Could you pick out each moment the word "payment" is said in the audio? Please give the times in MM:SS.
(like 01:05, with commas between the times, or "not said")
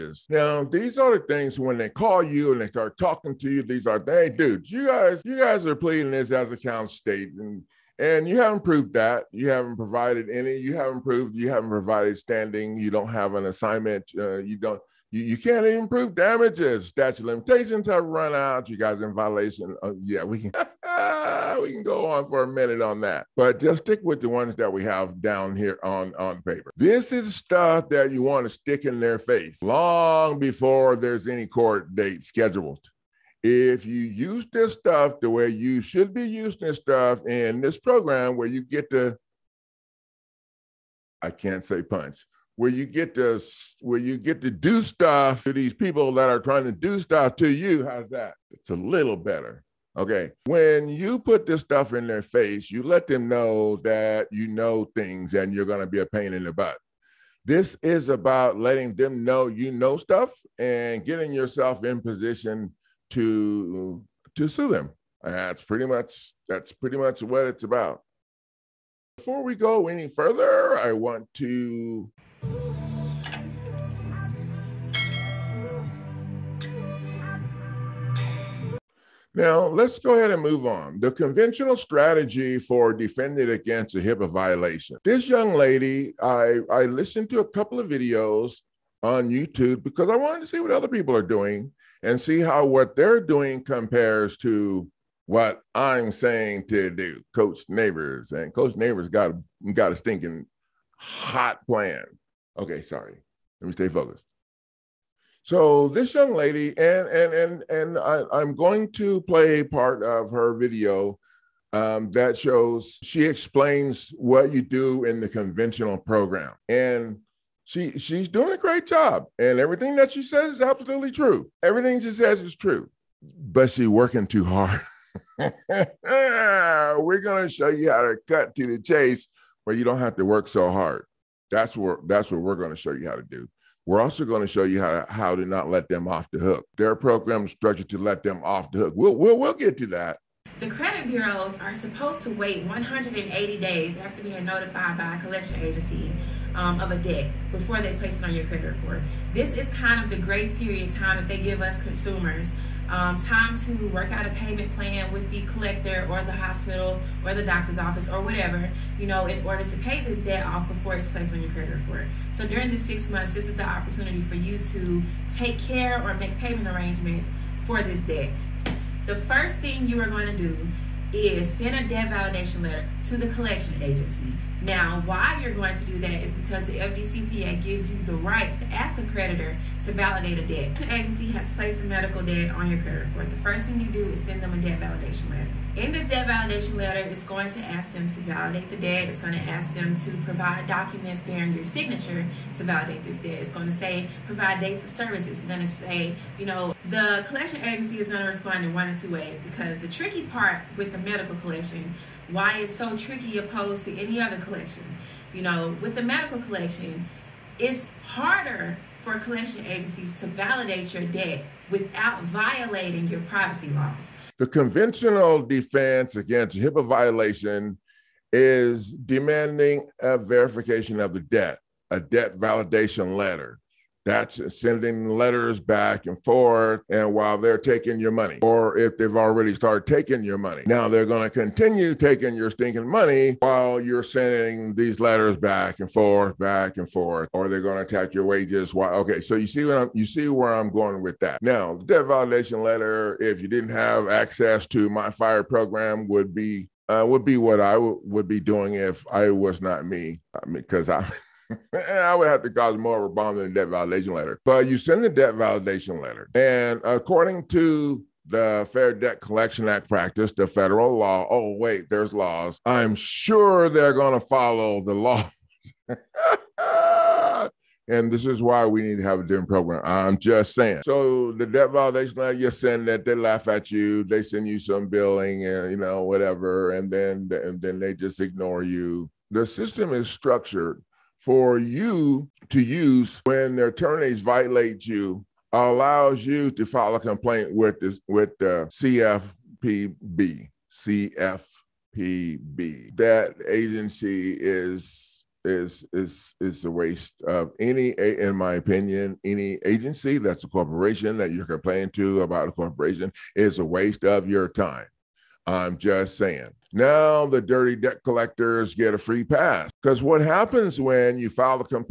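02:34, 02:46.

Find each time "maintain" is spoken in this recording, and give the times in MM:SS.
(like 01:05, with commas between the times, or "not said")
not said.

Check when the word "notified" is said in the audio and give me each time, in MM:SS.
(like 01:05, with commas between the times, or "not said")
02:24.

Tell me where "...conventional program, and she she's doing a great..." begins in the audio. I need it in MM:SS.
01:55.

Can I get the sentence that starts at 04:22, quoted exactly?
I'm sure they're going to follow the laws.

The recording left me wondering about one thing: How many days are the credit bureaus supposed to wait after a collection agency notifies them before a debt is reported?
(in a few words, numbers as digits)
180.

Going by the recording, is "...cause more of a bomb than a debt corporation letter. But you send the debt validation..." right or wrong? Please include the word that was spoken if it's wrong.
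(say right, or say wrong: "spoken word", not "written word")
wrong: "validation", not "corporation".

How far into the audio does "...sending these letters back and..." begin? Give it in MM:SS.
03:54.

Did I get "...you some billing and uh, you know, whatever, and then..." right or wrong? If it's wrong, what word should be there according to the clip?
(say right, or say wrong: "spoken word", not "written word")
right.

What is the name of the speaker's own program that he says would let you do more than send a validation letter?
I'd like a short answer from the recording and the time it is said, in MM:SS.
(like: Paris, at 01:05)
fire program, at 04:05.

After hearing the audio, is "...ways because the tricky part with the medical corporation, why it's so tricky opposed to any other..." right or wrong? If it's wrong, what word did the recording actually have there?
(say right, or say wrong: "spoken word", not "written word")
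wrong: "collection", not "corporation".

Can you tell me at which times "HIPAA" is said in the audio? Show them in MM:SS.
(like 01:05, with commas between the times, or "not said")
01:23, 03:36.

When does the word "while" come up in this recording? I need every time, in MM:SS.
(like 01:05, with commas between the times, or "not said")
03:47, 03:53.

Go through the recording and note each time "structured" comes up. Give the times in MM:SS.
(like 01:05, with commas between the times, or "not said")
02:17, 04:40.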